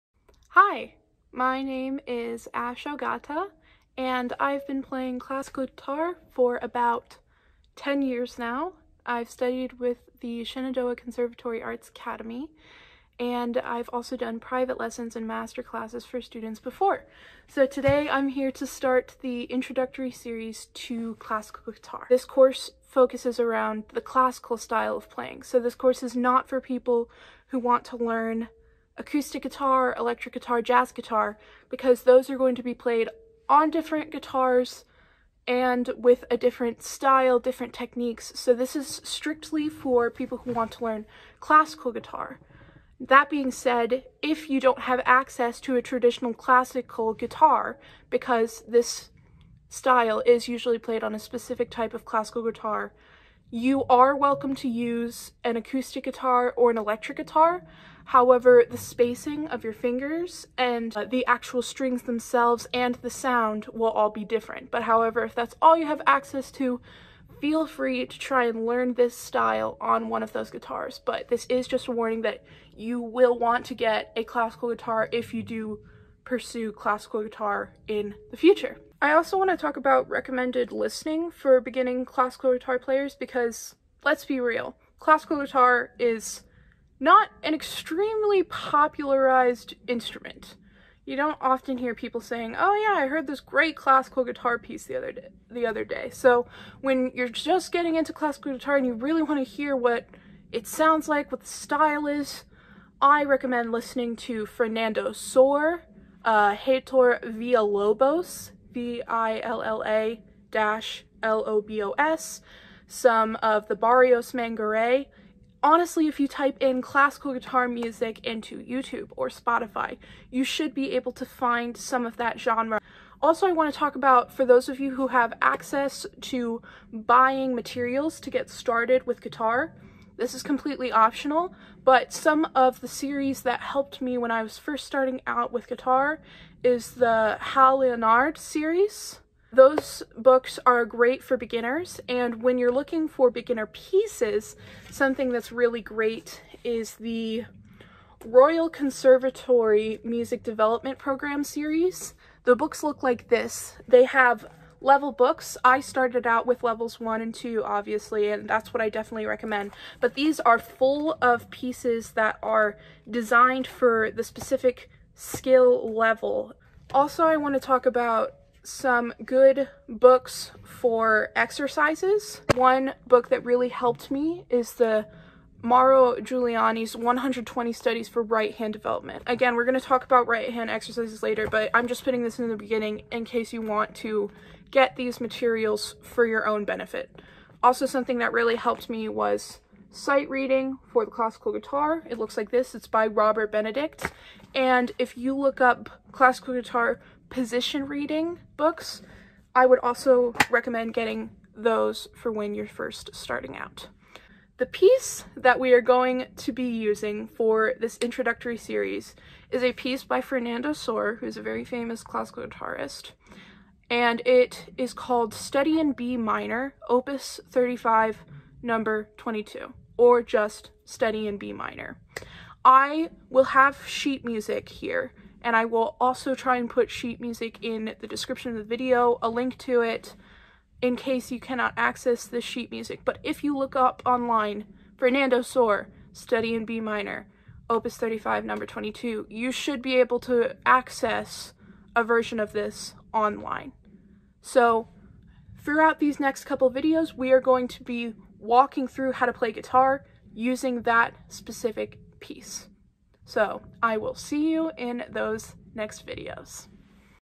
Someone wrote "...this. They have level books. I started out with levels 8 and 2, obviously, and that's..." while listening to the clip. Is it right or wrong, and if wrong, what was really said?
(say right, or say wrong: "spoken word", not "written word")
wrong: "1", not "8".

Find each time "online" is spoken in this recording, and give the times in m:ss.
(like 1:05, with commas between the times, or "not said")
3:54, 4:03.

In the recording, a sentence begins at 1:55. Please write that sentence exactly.
Honestly, if you type in classical guitar music into YouTube or Spotify, you should be able to find some of that genre.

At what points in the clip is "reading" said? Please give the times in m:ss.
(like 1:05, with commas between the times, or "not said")
3:10, 3:17.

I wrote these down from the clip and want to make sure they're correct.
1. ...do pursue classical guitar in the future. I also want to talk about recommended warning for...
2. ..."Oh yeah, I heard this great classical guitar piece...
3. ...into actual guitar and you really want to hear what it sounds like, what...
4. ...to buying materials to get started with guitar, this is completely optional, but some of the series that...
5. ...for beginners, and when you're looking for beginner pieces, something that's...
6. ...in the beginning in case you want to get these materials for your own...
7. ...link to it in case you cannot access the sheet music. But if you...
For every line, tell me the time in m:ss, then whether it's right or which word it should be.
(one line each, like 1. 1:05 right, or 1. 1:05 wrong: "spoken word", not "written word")
1. 1:15 wrong: "listening", not "warning"
2. 1:32 right
3. 1:37 wrong: "classical", not "actual"
4. 2:06 right
5. 2:21 right
6. 3:02 right
7. 3:49 right.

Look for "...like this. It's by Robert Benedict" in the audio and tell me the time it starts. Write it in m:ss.
3:12.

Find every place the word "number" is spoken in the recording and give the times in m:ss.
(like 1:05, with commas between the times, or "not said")
3:38, 3:58.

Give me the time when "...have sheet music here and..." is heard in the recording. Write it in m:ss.
3:43.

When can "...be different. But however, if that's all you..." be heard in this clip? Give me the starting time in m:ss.
1:04.